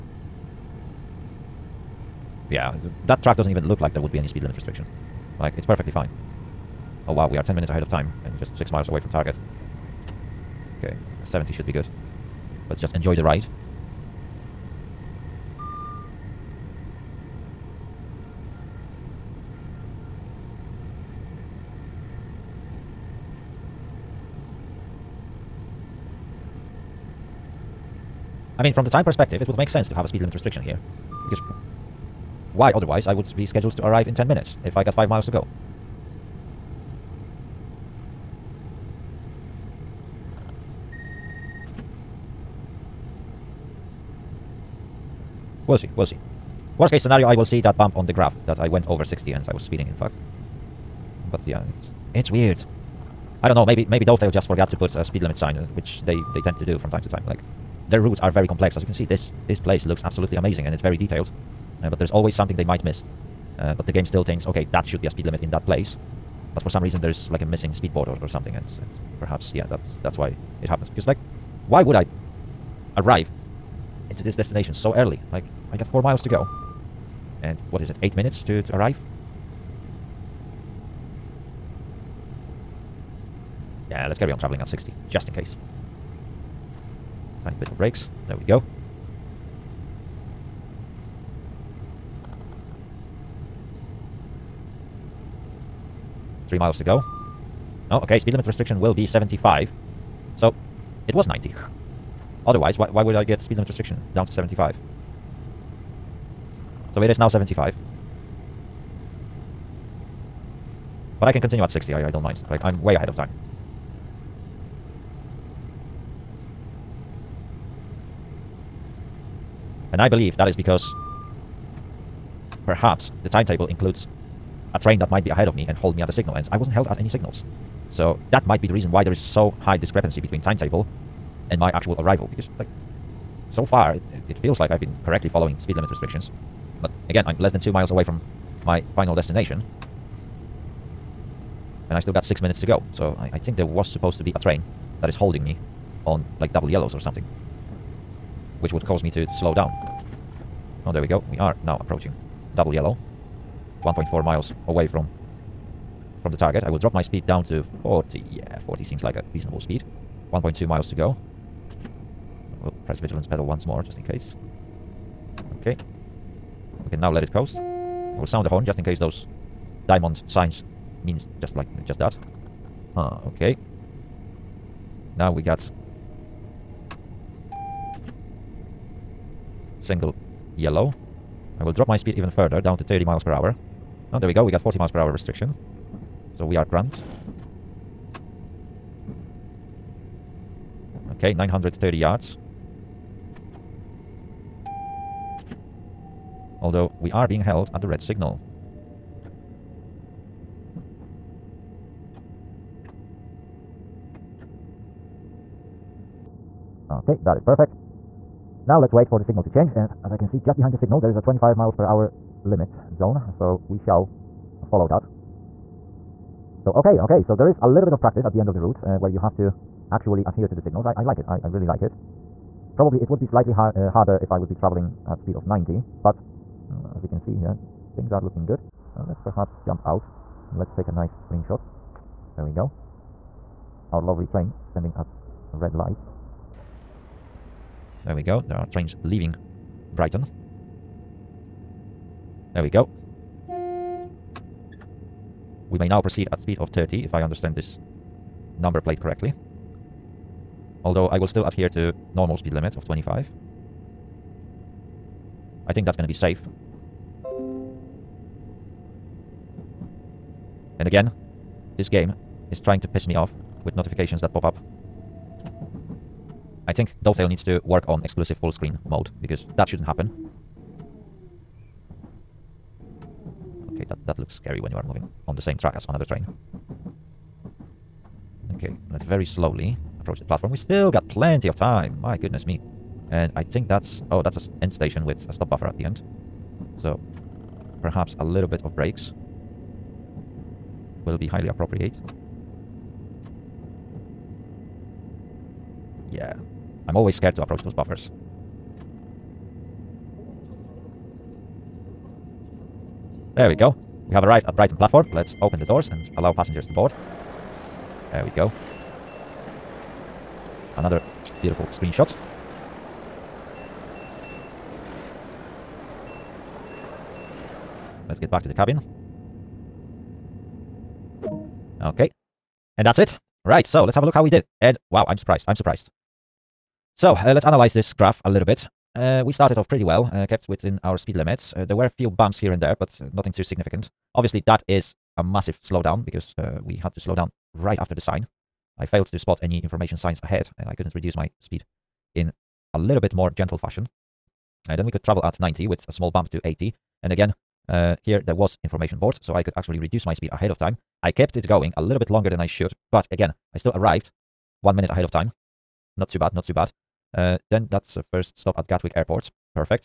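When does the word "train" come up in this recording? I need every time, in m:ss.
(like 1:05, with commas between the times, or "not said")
2:04, 2:24, 3:54, 3:58, 4:36.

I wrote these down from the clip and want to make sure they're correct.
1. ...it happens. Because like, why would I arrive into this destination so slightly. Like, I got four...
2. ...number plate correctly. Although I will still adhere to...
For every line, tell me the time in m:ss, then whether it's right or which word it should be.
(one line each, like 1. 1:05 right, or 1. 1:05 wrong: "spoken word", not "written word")
1. 1:10 wrong: "early", not "slightly"
2. 4:08 right.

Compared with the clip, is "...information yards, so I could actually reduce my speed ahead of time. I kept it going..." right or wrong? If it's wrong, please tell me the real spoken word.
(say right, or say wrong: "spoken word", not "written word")
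wrong: "boards", not "yards".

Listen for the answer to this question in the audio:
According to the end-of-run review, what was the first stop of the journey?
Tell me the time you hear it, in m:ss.
5:58.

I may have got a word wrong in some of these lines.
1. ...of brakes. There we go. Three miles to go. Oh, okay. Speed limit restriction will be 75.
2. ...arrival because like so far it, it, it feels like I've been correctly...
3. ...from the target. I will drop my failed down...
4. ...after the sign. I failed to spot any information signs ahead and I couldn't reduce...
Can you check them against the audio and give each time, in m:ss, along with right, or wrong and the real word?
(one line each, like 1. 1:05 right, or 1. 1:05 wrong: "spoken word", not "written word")
1. 1:27 right
2. 2:11 right
3. 2:36 wrong: "speed", not "failed"
4. 5:37 right.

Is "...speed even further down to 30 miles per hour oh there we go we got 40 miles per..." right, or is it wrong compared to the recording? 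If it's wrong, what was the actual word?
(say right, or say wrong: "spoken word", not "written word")
right.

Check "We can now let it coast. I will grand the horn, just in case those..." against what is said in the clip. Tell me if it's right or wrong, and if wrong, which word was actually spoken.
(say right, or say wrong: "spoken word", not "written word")
wrong: "sound", not "grand".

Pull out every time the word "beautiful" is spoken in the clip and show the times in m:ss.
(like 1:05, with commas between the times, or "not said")
5:11.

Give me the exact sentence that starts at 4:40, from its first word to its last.
We still got plenty of time.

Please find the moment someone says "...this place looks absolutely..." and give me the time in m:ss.
0:59.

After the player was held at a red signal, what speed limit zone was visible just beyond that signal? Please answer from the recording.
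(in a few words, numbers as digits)
25 miles per hour.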